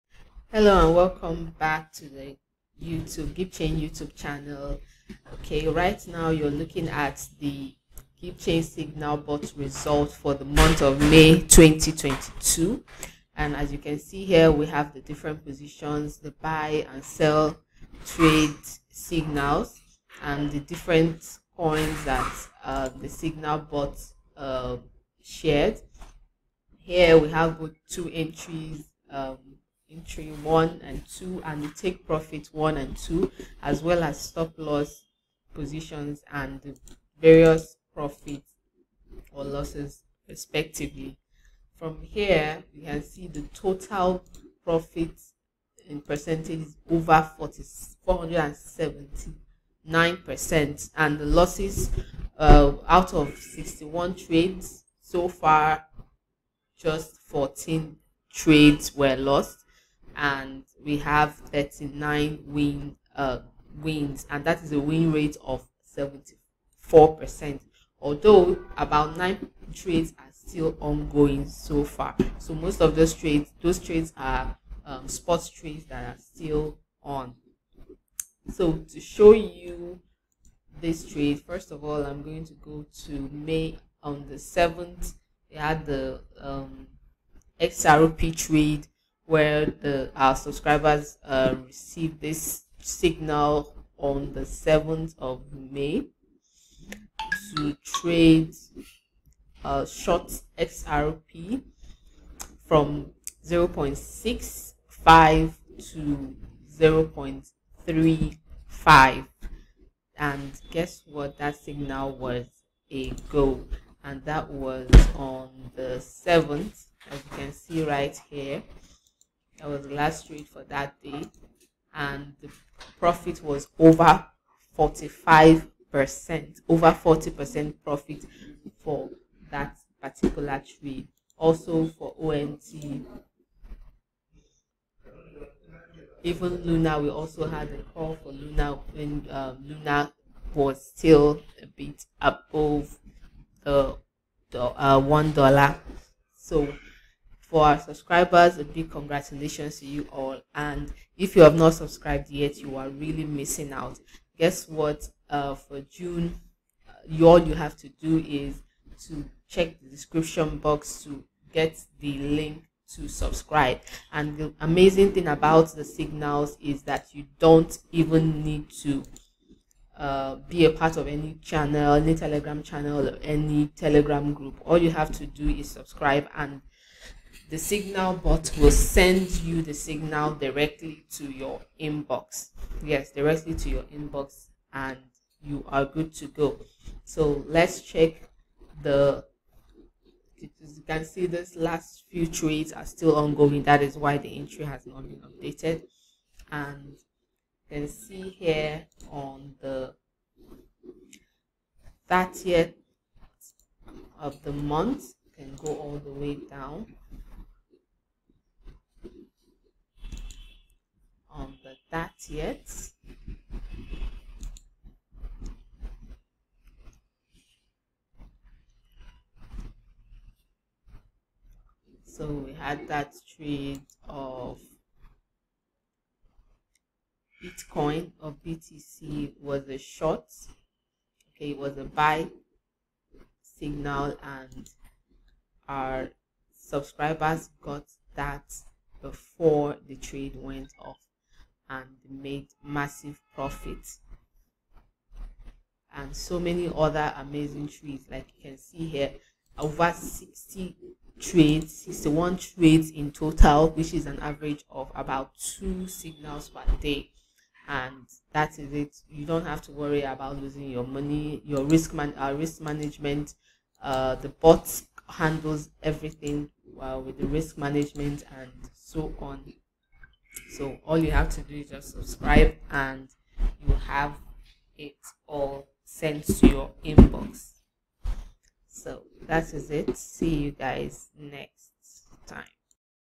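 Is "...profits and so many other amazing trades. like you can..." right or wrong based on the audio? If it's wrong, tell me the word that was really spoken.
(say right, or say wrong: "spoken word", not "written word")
right.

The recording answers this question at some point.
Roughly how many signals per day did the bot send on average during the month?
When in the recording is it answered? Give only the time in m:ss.
4:15.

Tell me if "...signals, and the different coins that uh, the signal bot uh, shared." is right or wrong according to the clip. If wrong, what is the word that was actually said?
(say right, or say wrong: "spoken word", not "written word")
right.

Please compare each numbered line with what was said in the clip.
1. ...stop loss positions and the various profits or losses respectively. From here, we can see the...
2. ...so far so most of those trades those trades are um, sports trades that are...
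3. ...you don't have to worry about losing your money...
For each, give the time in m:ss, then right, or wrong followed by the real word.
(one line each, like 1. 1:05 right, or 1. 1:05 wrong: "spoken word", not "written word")
1. 0:34 right
2. 1:11 right
3. 4:19 right.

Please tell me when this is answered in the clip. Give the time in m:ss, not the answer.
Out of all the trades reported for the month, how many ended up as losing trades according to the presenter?
0:57.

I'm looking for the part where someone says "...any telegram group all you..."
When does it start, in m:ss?
2:53.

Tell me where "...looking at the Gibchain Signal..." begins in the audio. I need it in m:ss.
0:06.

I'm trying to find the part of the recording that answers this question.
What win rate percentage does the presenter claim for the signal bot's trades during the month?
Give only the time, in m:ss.
1:05.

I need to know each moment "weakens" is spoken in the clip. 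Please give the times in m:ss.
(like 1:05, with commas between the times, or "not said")
not said.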